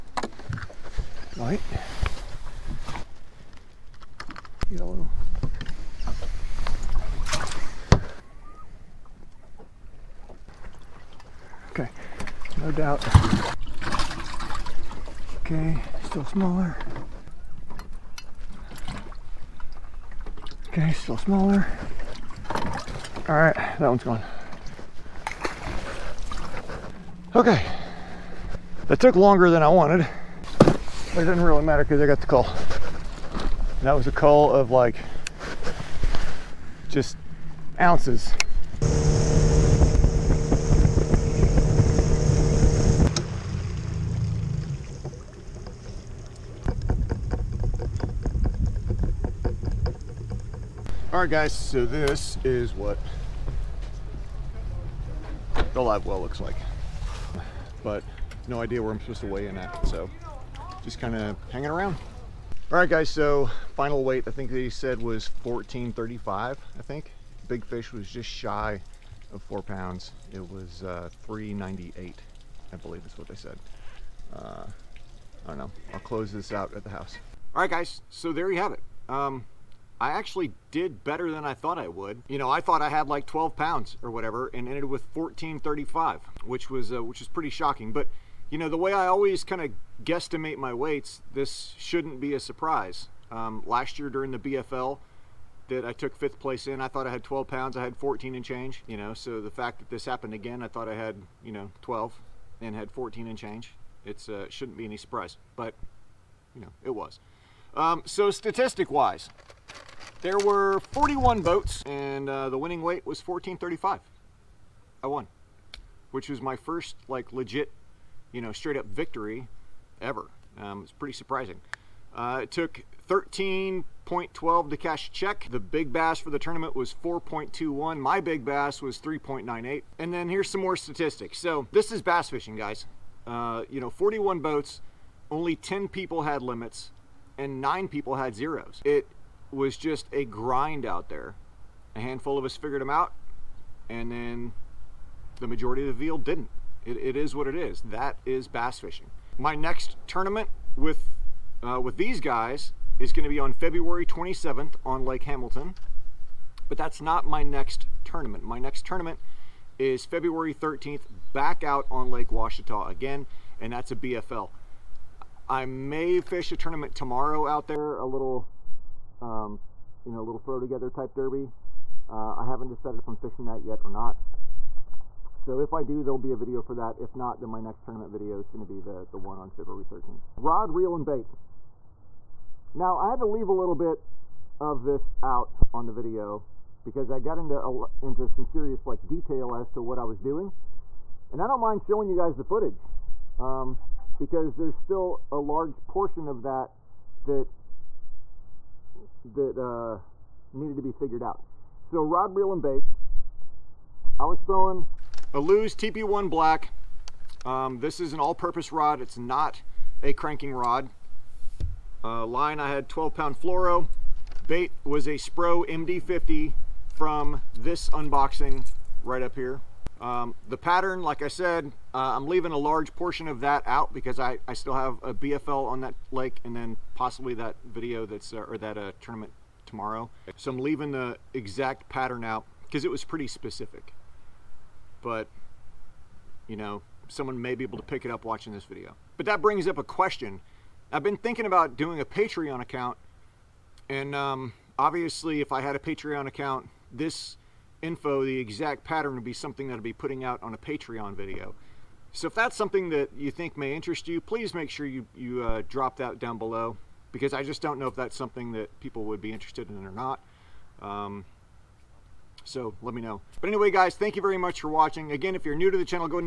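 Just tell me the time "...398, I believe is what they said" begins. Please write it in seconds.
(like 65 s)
71 s.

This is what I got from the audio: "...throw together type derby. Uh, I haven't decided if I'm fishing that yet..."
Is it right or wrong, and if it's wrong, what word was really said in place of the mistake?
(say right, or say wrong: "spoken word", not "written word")
right.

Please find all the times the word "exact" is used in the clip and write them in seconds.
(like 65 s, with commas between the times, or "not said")
231 s, 248 s.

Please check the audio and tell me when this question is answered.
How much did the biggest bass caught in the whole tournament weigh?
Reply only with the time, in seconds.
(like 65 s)
127 s.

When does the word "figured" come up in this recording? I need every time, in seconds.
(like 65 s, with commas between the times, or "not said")
142 s, 200 s.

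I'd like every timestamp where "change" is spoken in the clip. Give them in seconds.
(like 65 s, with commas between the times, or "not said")
98 s, 103 s.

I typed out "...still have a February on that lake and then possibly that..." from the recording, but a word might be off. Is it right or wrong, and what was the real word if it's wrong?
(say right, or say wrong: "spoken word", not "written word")
wrong: "BFL", not "February".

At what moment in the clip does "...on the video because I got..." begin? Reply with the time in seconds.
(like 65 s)
185 s.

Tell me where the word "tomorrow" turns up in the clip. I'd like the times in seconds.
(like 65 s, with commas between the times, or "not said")
166 s, 229 s.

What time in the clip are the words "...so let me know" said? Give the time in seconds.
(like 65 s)
262 s.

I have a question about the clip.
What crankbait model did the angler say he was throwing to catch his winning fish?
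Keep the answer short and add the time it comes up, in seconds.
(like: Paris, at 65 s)
Spro MD50, at 215 s.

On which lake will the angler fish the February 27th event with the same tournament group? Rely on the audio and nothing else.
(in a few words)
Lake Hamilton.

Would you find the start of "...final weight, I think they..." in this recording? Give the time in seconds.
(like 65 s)
63 s.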